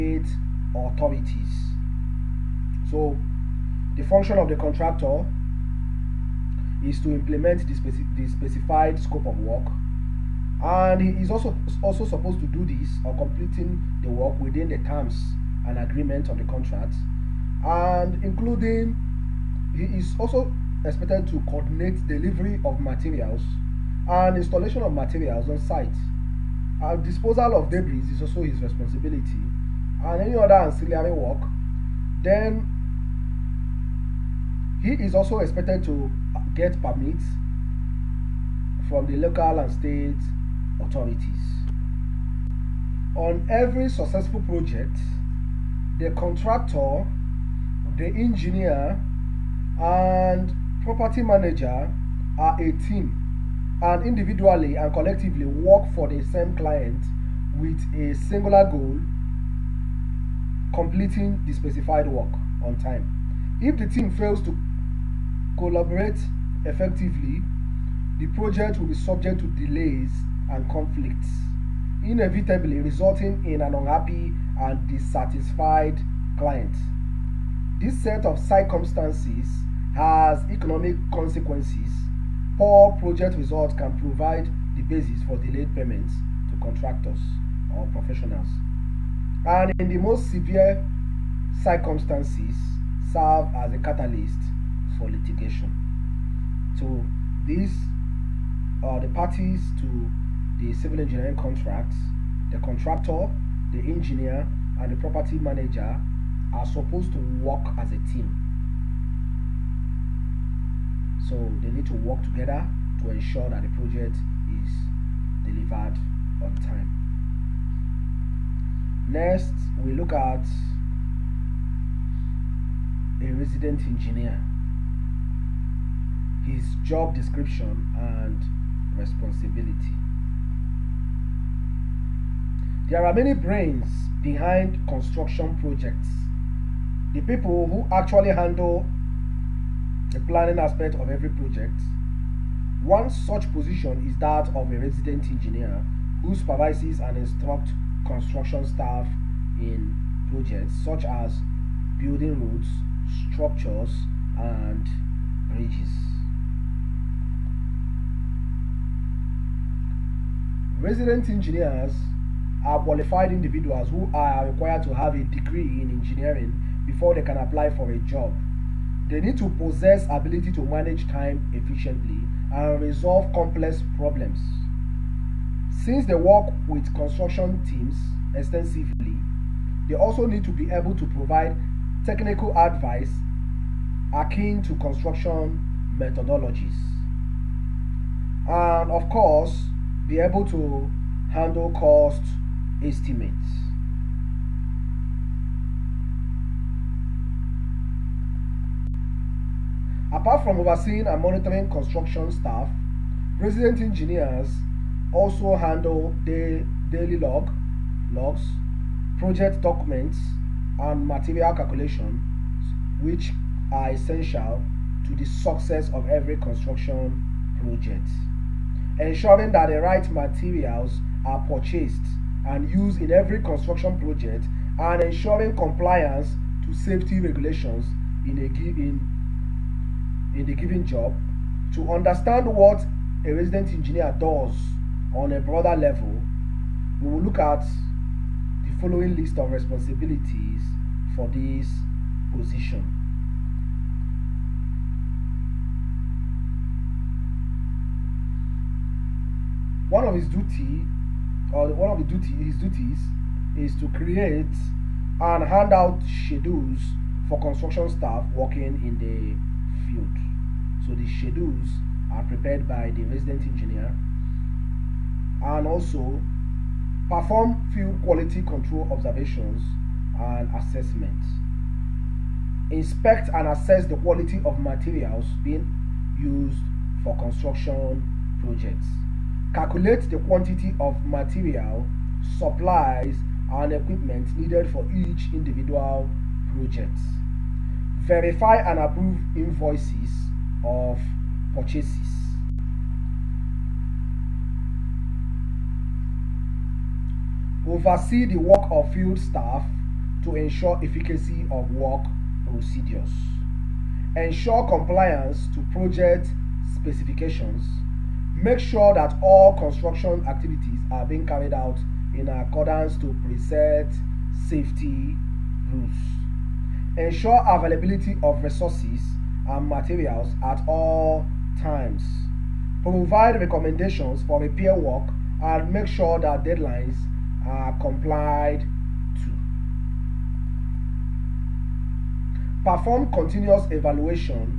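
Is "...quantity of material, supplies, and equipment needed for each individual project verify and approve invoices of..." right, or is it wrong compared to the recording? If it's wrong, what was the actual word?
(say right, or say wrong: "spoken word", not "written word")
right.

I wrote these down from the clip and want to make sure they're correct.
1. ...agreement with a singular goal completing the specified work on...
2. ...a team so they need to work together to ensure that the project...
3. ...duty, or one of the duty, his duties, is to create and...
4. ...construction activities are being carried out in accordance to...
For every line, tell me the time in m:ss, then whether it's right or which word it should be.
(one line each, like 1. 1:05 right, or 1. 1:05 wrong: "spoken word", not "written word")
1. 0:56 wrong: "client", not "agreement"
2. 1:47 right
3. 4:10 right
4. 5:09 right.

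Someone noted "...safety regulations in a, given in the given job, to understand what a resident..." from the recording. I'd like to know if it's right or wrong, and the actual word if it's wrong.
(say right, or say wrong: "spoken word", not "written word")
right.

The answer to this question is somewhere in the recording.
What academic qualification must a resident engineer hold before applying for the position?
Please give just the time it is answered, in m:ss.
2:45.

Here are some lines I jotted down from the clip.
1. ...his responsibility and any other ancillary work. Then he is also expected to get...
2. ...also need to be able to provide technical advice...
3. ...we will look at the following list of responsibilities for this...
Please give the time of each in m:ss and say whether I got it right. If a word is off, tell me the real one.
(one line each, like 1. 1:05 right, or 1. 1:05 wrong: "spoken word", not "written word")
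1. 0:28 right
2. 2:59 right
3. 3:56 right.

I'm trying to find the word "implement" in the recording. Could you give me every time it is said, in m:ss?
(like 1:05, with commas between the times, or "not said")
0:07.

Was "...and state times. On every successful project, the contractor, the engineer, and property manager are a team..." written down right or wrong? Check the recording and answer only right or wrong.
wrong.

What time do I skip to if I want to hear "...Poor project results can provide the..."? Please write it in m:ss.
1:22.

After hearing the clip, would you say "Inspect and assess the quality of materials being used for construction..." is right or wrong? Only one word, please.
right.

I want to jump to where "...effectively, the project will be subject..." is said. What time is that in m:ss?
1:06.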